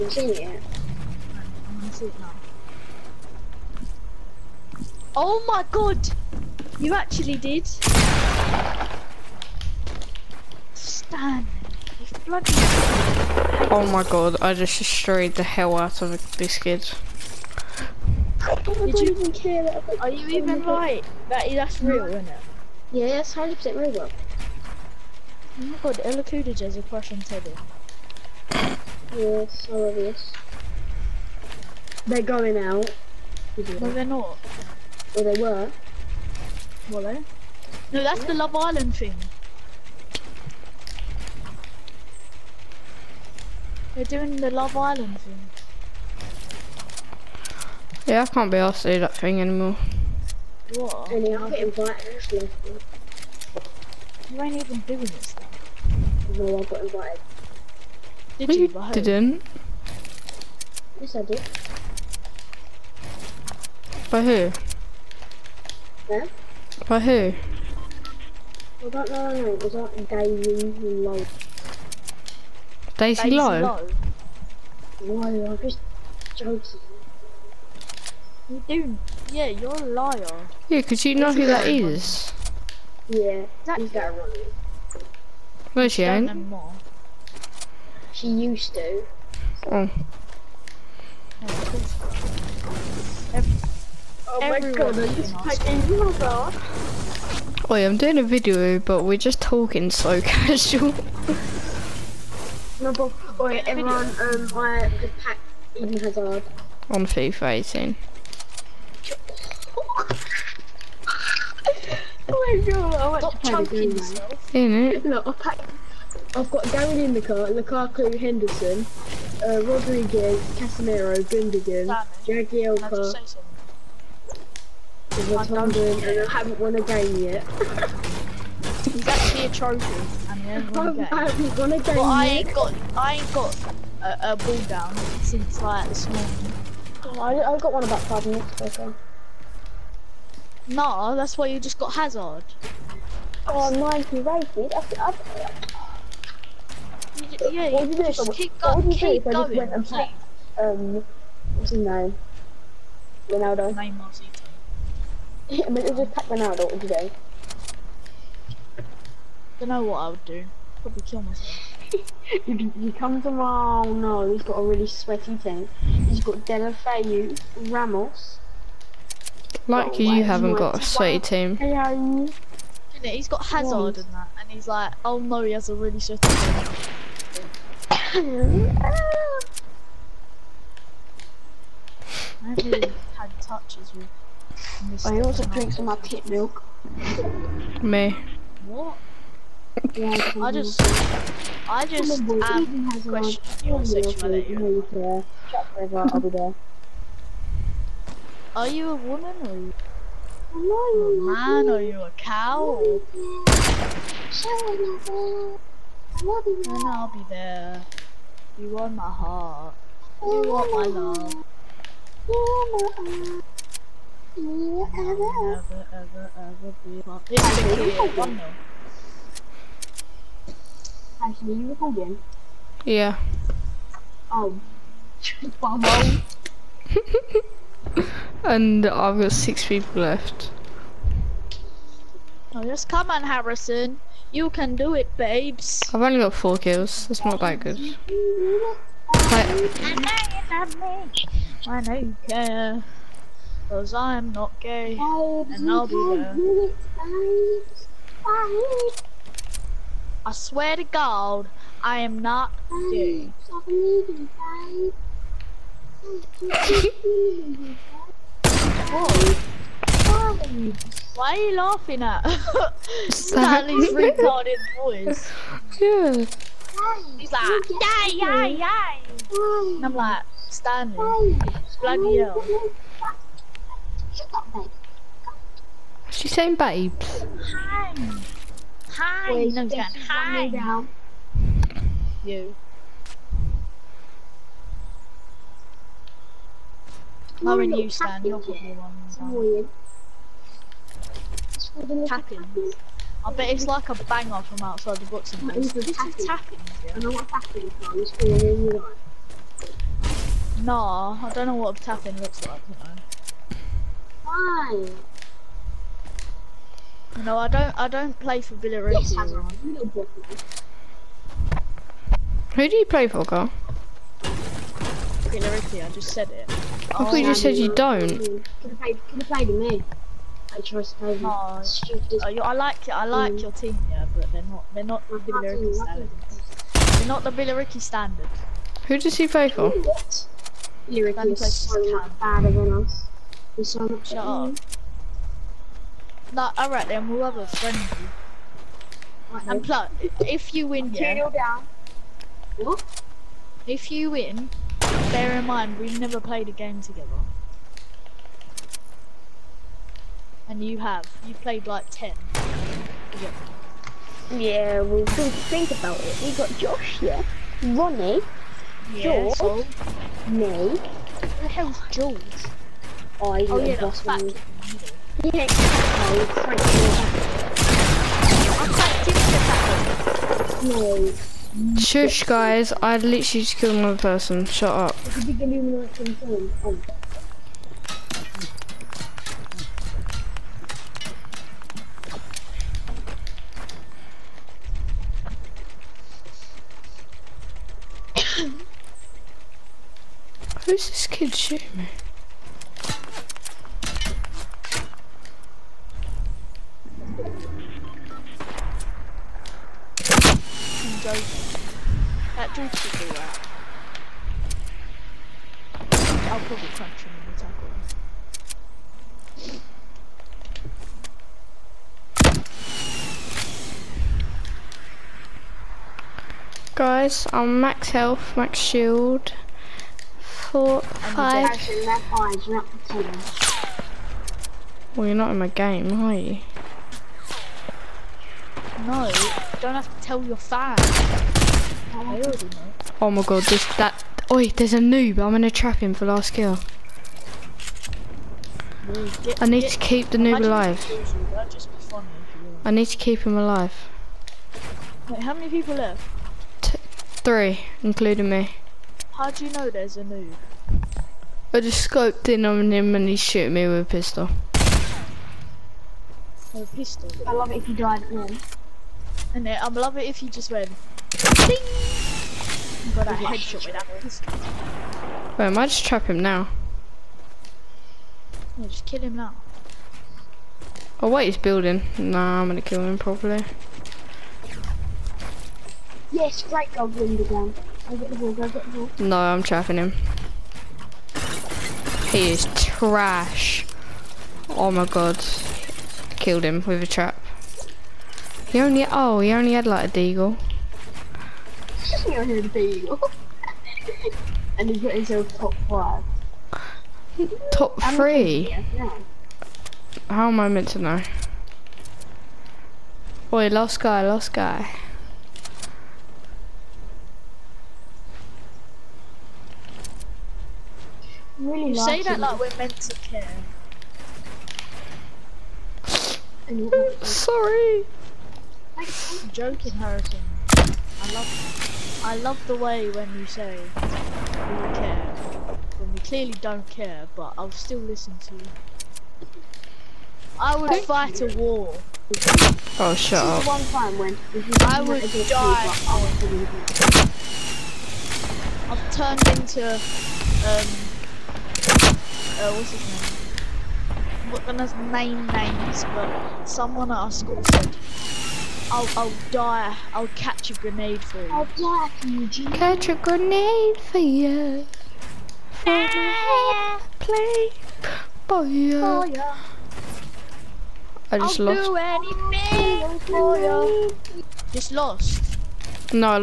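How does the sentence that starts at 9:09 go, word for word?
I'll catch a grenade for you.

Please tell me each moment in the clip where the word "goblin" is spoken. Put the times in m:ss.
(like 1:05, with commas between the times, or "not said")
7:56.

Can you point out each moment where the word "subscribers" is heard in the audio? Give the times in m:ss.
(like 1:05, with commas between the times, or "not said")
not said.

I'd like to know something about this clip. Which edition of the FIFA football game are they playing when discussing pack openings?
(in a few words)
FIFA 18.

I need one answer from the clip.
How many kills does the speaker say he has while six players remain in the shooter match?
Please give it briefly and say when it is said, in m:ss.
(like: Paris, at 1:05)
4, at 3:56.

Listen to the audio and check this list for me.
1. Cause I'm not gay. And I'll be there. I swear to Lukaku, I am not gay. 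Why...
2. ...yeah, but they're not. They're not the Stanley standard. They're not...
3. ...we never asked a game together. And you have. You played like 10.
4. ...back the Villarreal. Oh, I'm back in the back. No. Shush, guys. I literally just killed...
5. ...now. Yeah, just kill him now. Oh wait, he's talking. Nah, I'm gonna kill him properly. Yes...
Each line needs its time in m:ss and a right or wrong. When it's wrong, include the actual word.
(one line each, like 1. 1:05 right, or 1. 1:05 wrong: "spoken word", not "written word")
1. 4:03 wrong: "God", not "Lukaku"
2. 5:23 wrong: "Billericay", not "Stanley"
3. 5:45 wrong: "played", not "asked"
4. 6:04 wrong: "Yeah", not "Villarreal"
5. 7:46 wrong: "building", not "talking".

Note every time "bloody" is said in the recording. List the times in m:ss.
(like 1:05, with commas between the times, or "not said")
0:12, 4:31.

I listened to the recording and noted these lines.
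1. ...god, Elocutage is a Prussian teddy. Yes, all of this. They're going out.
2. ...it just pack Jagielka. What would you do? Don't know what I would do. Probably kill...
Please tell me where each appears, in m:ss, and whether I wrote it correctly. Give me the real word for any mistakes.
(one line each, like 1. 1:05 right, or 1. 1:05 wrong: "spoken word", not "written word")
1. 0:25 right
2. 2:35 wrong: "Ronaldo", not "Jagielka".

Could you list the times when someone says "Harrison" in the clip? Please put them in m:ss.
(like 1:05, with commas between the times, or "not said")
3:53, 8:39.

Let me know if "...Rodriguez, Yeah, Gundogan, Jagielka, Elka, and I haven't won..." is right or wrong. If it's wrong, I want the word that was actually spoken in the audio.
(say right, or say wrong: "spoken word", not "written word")
wrong: "Casemiro", not "Yeah".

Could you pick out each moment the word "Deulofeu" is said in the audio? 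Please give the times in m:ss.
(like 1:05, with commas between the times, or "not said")
2:46.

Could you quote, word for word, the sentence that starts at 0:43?
They're doing the Love Island thing.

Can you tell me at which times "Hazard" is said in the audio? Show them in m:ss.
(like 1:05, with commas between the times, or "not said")
1:45, 2:21, 2:53.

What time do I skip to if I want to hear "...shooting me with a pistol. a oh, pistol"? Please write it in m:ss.
7:33.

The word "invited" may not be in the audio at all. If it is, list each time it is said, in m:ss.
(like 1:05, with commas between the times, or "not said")
0:51, 0:56.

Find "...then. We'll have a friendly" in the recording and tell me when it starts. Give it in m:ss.
5:36.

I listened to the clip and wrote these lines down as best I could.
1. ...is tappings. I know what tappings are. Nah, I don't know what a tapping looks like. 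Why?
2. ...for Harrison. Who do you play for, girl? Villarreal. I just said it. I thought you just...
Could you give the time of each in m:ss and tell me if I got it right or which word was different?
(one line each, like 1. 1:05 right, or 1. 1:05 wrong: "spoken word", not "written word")
1. 4:55 right
2. 5:08 wrong: "Villarreal", not "Harrison".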